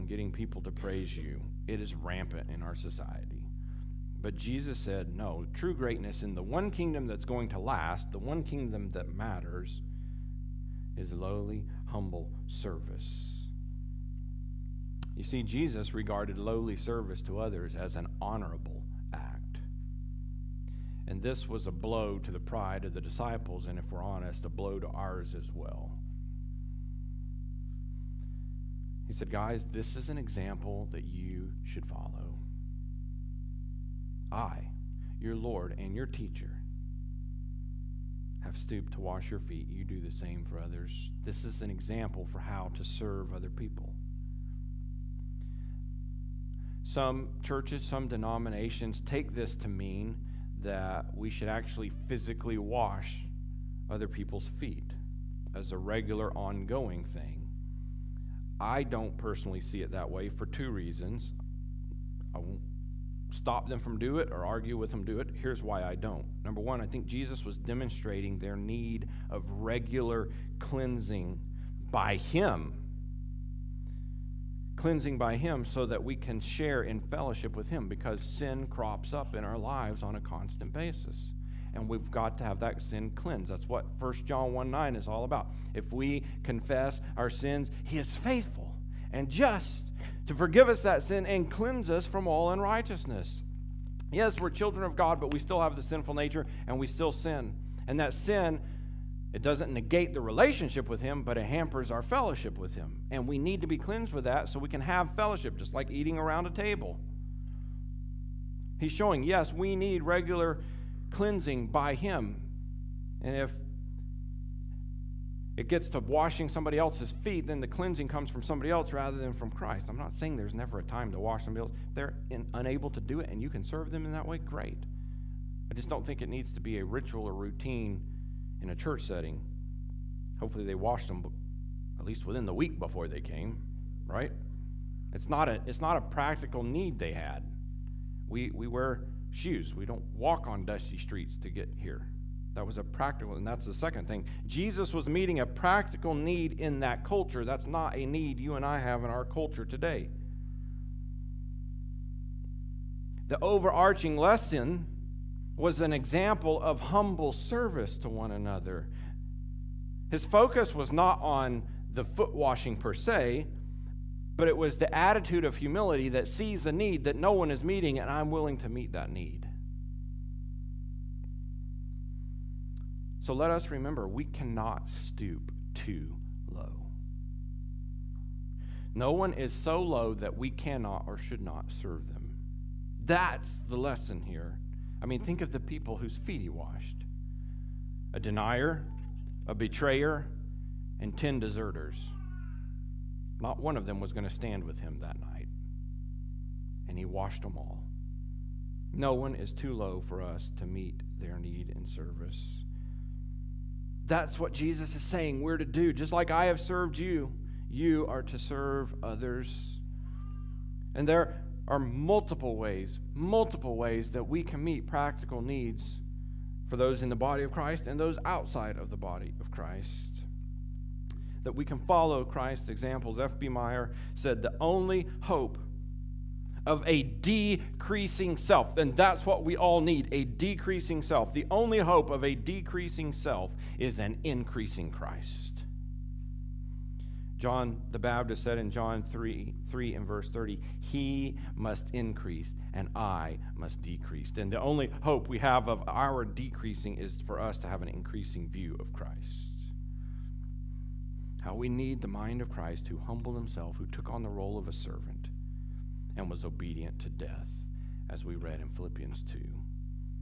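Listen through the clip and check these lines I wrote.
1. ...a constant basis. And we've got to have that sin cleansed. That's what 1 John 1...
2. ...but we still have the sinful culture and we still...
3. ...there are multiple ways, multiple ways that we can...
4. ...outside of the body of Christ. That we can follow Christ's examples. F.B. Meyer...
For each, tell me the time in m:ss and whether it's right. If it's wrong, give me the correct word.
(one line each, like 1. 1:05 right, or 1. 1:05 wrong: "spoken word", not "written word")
1. 1:20 right
2. 1:35 wrong: "nature", not "culture"
3. 3:31 right
4. 3:38 right.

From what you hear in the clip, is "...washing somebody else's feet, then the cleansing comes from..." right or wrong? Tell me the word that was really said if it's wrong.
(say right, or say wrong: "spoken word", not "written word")
right.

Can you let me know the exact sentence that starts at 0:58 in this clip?
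I don't personally see it that way for two reasons.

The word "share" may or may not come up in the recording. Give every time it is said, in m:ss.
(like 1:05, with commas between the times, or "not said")
1:16.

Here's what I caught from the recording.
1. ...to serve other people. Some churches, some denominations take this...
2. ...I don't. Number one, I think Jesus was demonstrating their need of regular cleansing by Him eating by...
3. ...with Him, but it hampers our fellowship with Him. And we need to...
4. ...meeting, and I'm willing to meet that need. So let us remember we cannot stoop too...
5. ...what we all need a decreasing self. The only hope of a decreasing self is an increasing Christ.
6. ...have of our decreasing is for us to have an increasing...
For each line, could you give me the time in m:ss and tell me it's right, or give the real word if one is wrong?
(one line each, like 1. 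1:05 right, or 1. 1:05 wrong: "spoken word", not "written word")
1. 0:42 right
2. 1:05 wrong: "cleansing", not "eating"
3. 1:40 right
4. 2:47 right
5. 3:49 right
6. 4:05 right.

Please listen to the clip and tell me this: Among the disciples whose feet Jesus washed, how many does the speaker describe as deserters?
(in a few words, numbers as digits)
10.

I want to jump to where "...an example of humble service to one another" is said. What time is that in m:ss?
2:35.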